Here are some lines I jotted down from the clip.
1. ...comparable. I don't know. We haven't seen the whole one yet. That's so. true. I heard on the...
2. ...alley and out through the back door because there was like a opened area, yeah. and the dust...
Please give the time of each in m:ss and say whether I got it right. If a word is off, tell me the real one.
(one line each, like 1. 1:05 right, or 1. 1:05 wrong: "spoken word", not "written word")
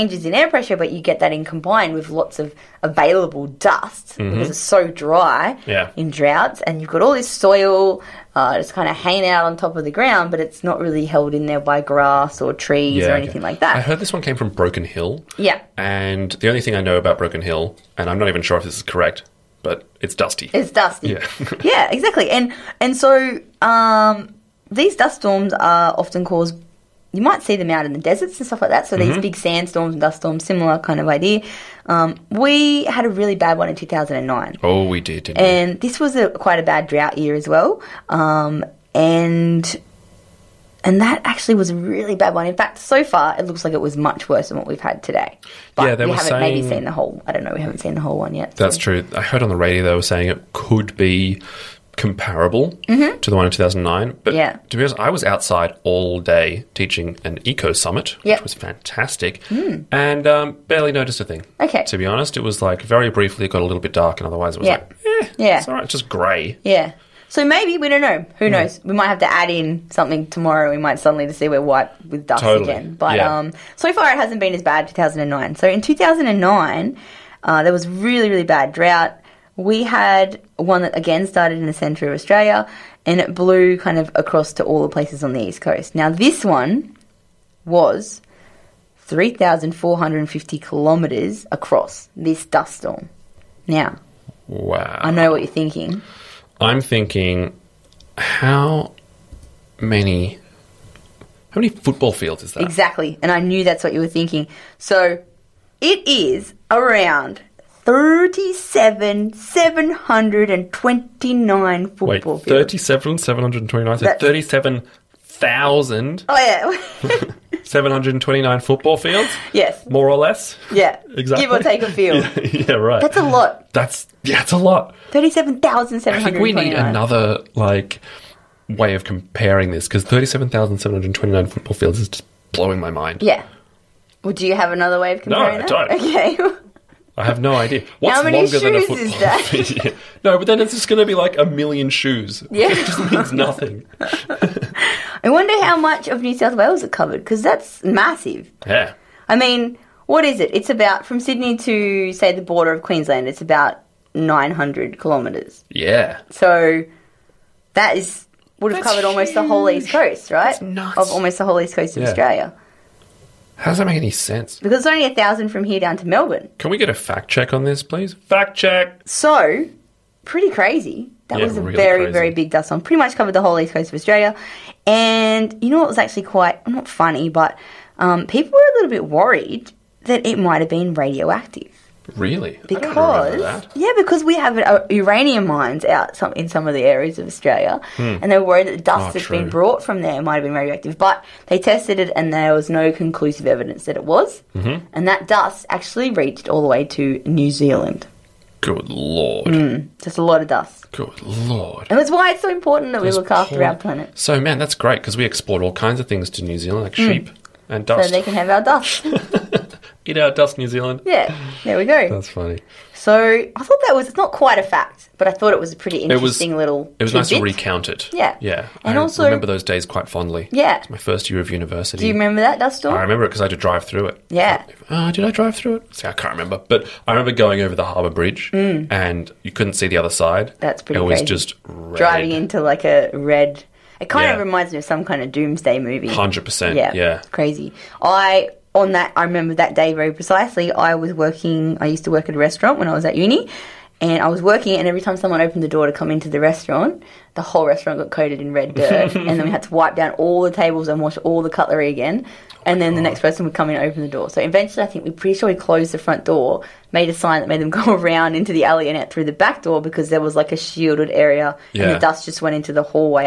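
1. 0:46 wrong: "whole", not "comparable"
2. 4:18 wrong: "shielded", not "opened".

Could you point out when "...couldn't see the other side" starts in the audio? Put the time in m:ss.
3:49.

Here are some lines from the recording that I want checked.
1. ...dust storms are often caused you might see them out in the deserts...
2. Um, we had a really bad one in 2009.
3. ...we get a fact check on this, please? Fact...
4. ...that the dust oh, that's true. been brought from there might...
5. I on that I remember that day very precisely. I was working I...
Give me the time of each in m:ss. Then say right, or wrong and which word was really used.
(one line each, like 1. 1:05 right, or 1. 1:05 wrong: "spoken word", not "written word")
1. 0:24 right
2. 0:31 right
3. 2:46 right
4. 3:08 right
5. 3:58 right.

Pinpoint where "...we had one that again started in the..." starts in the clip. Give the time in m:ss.
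1:19.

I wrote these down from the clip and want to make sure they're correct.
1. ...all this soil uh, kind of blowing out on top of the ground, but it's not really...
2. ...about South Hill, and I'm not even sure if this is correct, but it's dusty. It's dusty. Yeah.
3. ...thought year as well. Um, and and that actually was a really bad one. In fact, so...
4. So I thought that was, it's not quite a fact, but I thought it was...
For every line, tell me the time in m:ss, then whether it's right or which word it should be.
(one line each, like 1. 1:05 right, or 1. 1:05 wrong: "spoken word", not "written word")
1. 0:07 wrong: "hanging", not "blowing"
2. 0:16 wrong: "Broken", not "South"
3. 0:36 wrong: "drought", not "thought"
4. 3:32 right.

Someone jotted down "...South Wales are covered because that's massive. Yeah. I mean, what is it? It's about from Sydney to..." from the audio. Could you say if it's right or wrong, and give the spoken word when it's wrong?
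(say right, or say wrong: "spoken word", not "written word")
right.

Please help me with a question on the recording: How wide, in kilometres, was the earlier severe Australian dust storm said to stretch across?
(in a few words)
3,450 kilometres.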